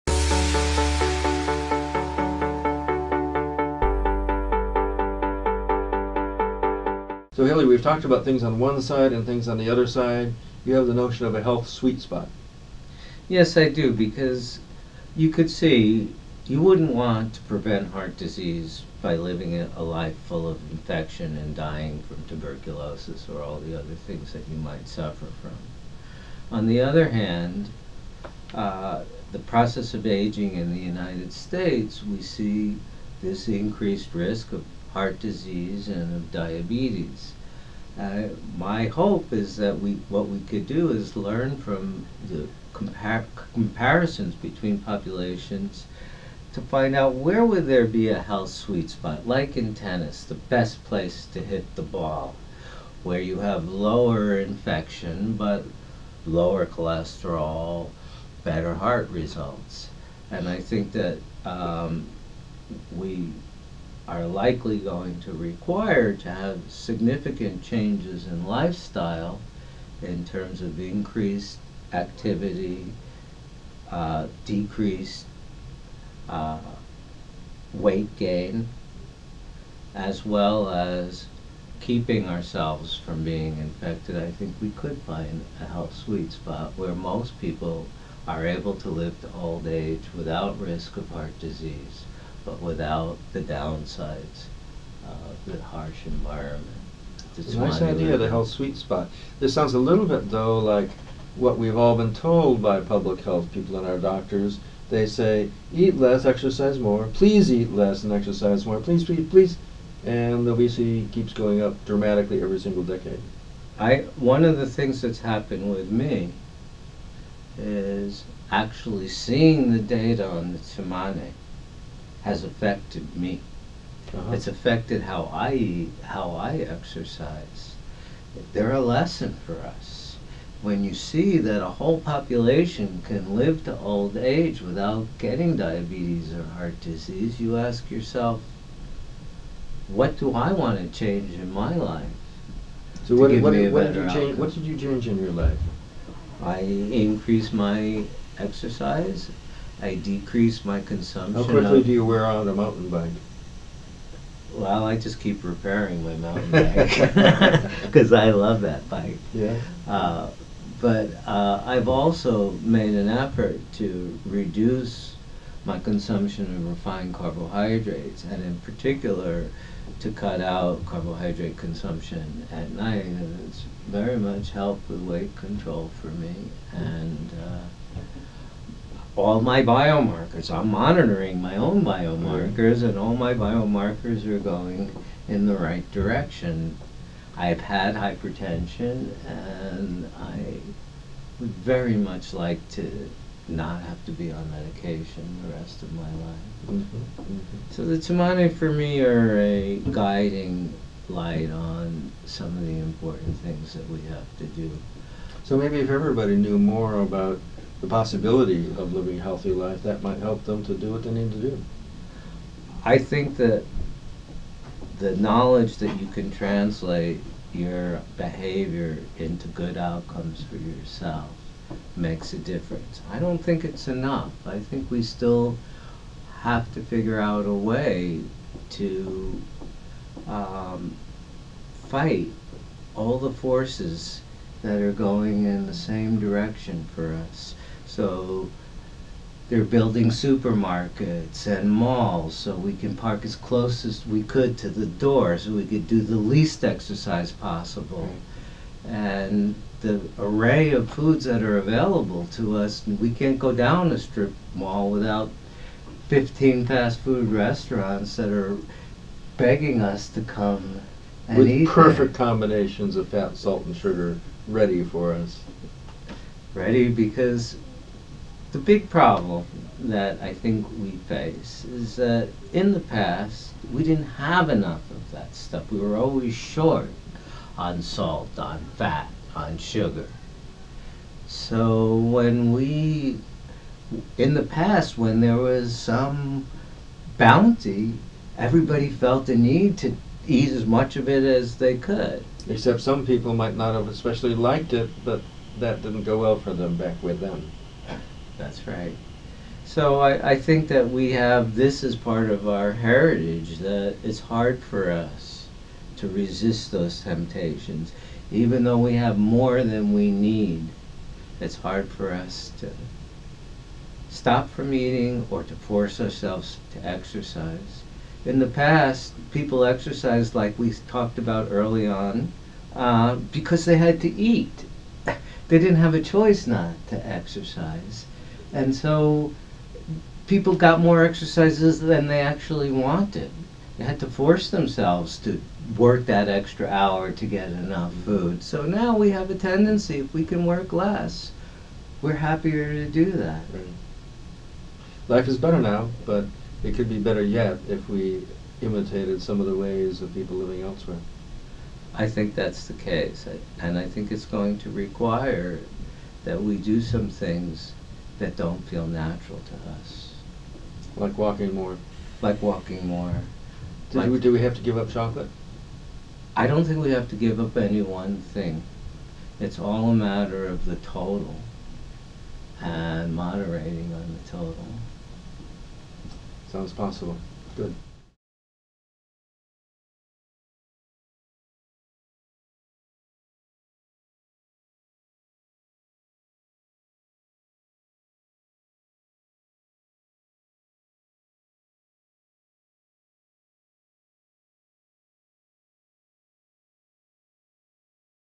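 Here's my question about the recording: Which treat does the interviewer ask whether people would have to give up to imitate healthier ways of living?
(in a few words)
chocolate.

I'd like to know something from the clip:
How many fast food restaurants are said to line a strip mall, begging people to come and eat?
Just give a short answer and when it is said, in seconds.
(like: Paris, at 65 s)
15, at 256 s.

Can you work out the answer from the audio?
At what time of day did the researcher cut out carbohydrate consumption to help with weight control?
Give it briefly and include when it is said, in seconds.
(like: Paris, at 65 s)
at night, at 172 s.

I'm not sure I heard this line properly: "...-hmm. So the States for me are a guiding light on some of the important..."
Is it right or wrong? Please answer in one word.
wrong.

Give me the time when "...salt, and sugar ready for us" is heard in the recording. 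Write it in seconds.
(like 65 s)
263 s.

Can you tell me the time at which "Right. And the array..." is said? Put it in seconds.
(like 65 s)
248 s.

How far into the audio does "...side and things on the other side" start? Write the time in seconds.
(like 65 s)
8 s.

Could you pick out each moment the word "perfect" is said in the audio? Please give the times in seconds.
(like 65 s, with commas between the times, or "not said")
261 s.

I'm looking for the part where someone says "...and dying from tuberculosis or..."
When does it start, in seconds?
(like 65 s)
21 s.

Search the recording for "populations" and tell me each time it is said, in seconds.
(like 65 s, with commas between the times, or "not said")
44 s, 132 s.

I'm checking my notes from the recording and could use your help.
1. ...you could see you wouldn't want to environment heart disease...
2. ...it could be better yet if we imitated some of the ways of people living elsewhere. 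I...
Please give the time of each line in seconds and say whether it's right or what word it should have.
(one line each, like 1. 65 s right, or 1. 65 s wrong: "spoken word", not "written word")
1. 15 s wrong: "prevent", not "environment"
2. 346 s right.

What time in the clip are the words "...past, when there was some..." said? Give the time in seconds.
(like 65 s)
284 s.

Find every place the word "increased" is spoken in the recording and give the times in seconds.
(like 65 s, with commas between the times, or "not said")
33 s, 70 s, 146 s.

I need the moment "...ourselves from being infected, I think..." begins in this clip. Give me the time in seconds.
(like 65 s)
82 s.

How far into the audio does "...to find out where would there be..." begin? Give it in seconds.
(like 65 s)
46 s.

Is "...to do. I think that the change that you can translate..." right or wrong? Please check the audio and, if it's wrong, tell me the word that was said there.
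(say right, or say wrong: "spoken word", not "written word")
wrong: "knowledge", not "change".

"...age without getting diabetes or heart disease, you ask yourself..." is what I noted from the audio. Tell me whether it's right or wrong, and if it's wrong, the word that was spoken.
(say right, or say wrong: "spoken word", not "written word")
right.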